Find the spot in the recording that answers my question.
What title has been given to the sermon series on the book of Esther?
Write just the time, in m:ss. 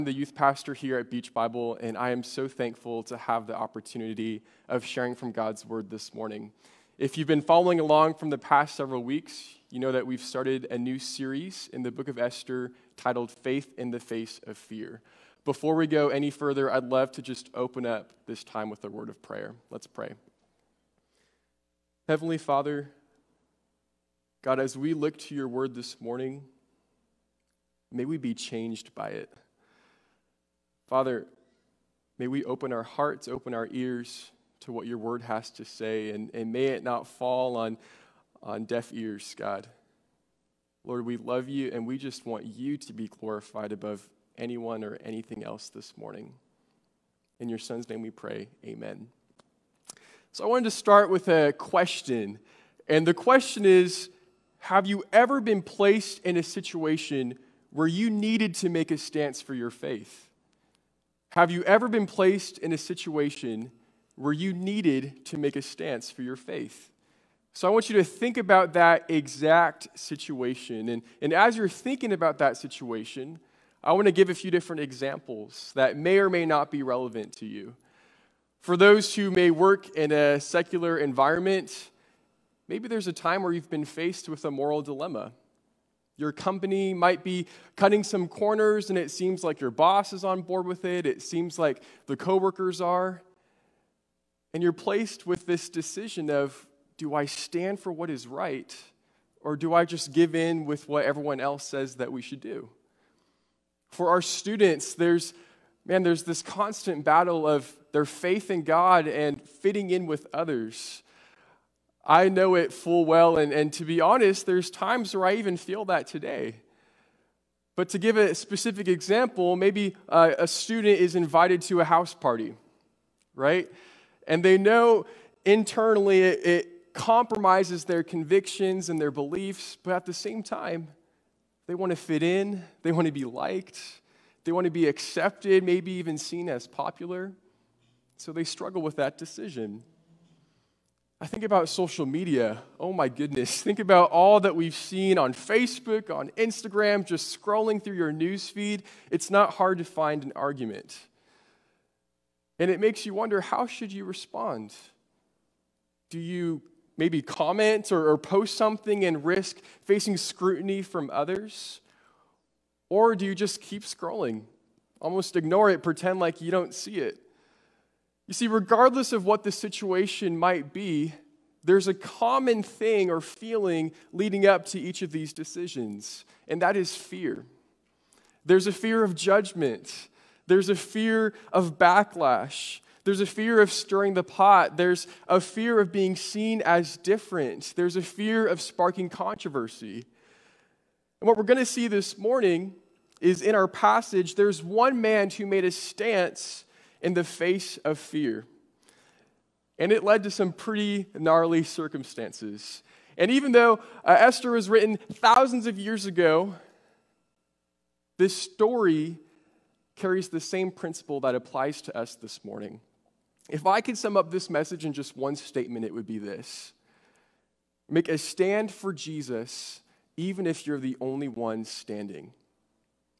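0:13.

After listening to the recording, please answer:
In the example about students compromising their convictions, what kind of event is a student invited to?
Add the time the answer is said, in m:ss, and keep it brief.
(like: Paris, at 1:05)
A house party, at 2:01.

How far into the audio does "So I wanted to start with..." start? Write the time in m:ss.
0:50.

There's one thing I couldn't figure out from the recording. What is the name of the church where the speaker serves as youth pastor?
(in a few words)
Beach Bible.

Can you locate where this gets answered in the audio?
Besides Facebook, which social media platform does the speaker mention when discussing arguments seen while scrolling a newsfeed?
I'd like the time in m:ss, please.
2:26.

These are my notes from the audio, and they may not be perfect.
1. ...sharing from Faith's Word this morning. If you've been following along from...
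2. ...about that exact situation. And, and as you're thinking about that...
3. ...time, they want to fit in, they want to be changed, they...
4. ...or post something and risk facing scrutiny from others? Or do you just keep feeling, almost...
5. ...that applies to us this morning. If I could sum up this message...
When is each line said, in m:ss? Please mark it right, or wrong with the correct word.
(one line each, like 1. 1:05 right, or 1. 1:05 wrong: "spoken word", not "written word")
1. 0:04 wrong: "God", not "Faith"
2. 1:08 right
3. 2:10 wrong: "liked", not "changed"
4. 2:38 wrong: "scrolling", not "feeling"
5. 3:31 right.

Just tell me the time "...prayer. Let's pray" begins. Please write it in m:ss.
0:19.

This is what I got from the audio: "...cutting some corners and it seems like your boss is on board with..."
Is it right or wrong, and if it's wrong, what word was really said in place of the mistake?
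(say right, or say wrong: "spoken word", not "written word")
right.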